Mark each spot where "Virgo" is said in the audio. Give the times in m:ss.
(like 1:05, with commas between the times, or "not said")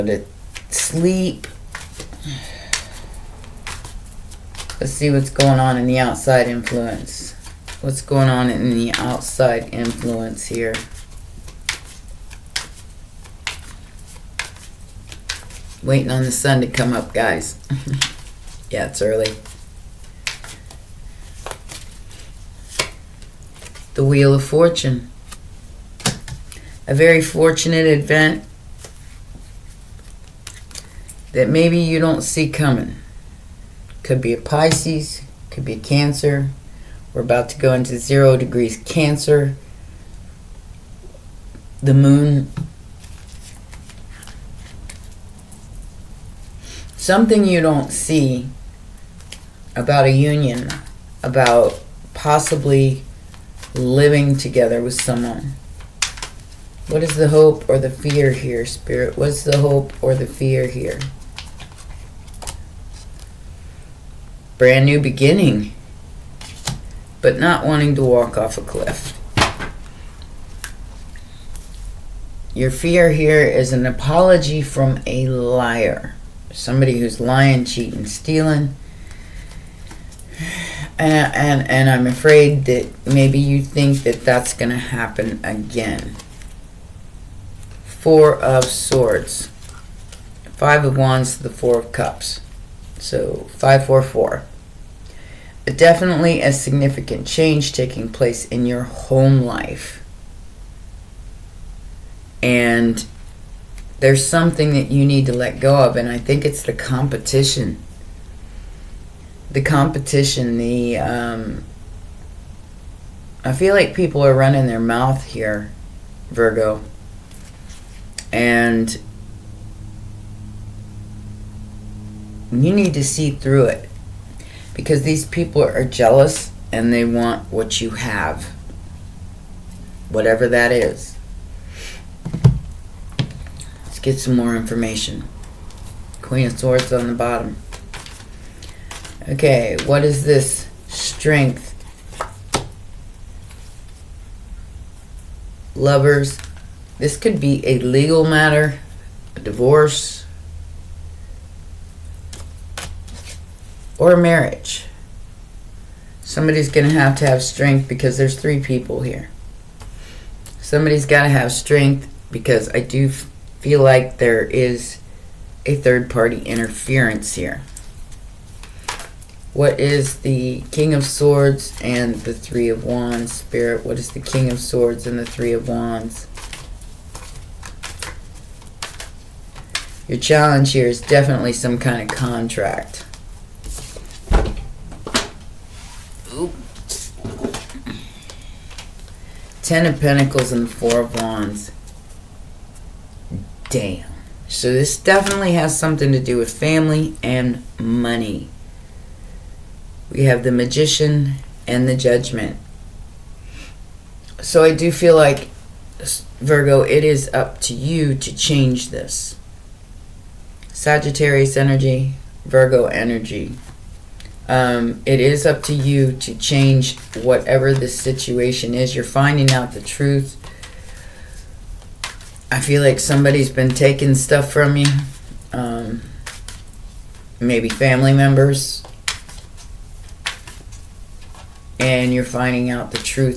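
1:56, 3:26, 3:32.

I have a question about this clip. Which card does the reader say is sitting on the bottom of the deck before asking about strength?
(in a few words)
Queen of Swords.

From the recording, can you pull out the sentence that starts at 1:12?
Your fear here is an apology from a liar, somebody who's lying, cheating, stealing.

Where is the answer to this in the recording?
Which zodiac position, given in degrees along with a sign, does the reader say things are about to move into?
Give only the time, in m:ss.
0:37.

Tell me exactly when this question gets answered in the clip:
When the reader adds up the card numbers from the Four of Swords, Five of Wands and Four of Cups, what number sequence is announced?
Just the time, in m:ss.
1:33.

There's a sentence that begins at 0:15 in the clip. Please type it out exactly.
Waiting on the sun to come up, guys.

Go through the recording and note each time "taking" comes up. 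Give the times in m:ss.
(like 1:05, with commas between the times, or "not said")
1:37, 3:43.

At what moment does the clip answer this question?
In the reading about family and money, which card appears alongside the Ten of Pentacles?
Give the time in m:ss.
3:10.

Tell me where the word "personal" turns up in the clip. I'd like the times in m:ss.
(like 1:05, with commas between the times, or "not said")
not said.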